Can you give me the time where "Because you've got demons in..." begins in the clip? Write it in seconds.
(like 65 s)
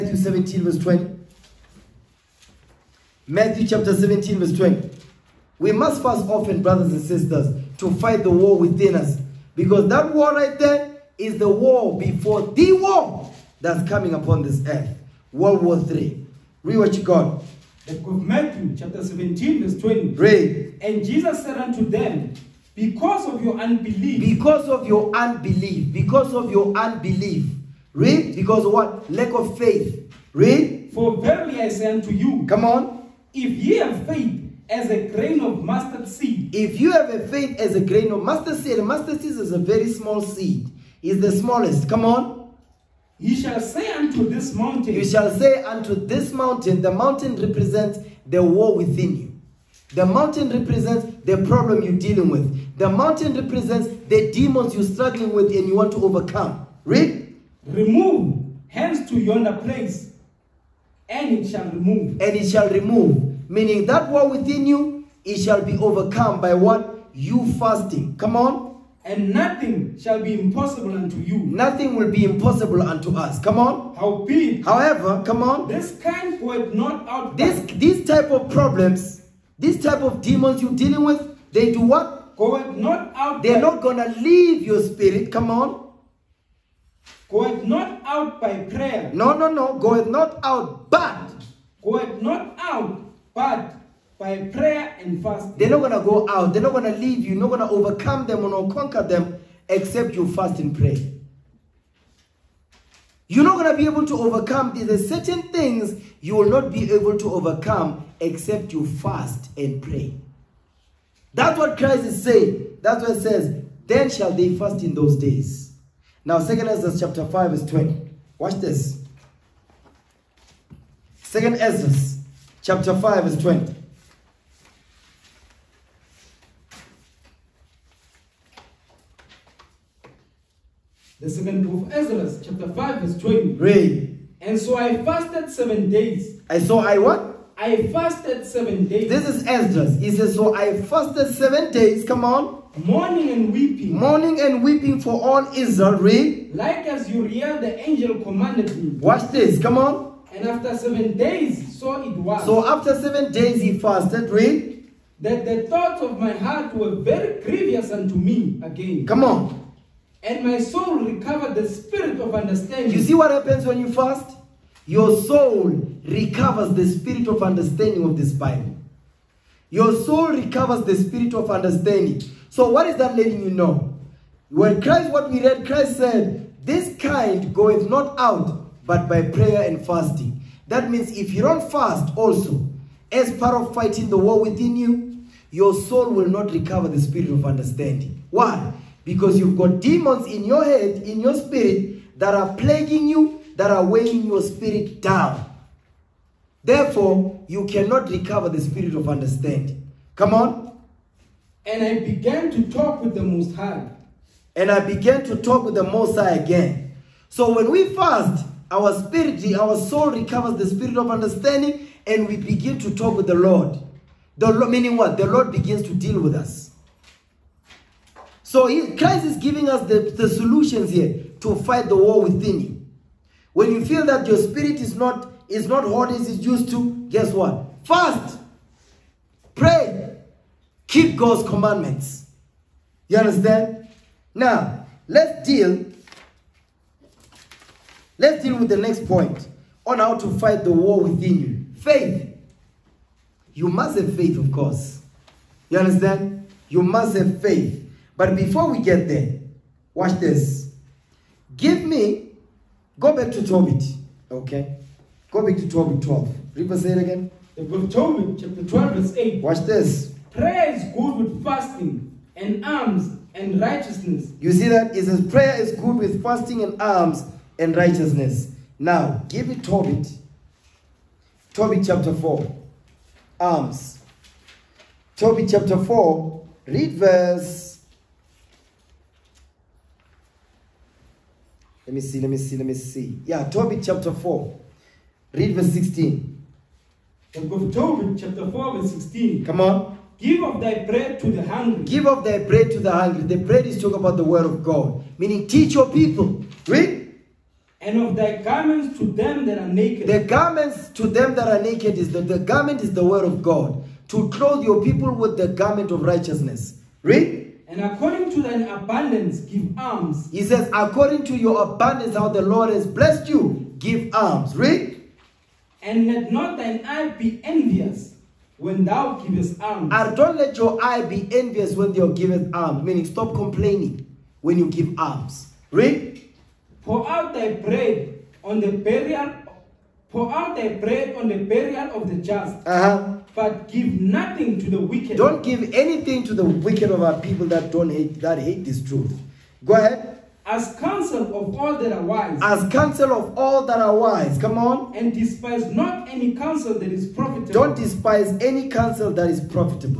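189 s.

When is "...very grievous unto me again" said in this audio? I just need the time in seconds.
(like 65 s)
156 s.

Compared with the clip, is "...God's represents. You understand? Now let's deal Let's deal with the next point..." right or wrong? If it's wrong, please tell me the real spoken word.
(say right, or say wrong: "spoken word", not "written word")
wrong: "commandments", not "represents".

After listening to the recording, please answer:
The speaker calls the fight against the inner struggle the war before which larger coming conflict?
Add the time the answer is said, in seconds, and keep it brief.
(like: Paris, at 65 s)
World War III, at 15 s.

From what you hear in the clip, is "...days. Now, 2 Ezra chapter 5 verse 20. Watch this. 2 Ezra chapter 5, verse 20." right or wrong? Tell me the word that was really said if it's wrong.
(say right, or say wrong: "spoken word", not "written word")
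right.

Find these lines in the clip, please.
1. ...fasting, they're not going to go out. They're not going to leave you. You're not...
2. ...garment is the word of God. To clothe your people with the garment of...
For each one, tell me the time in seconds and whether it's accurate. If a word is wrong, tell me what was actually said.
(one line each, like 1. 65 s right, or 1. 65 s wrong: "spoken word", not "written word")
1. 95 s right
2. 302 s right.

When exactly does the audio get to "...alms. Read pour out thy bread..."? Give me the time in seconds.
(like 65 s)
324 s.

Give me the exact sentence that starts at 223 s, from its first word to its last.
When you feel that your spirit is not is not hot as it's used to, guess what?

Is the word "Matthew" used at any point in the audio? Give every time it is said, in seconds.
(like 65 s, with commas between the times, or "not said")
3 s, 18 s.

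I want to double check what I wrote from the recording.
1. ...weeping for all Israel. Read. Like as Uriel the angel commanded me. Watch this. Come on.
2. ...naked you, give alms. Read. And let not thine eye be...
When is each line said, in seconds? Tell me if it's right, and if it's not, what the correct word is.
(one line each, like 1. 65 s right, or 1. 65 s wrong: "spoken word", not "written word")
1. 144 s right
2. 312 s wrong: "blessed", not "naked".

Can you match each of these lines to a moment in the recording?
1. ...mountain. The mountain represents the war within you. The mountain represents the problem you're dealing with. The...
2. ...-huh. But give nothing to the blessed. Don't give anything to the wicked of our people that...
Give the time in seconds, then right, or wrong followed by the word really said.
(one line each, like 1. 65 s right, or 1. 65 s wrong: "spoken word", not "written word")
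1. 46 s right
2. 332 s wrong: "wicked", not "blessed".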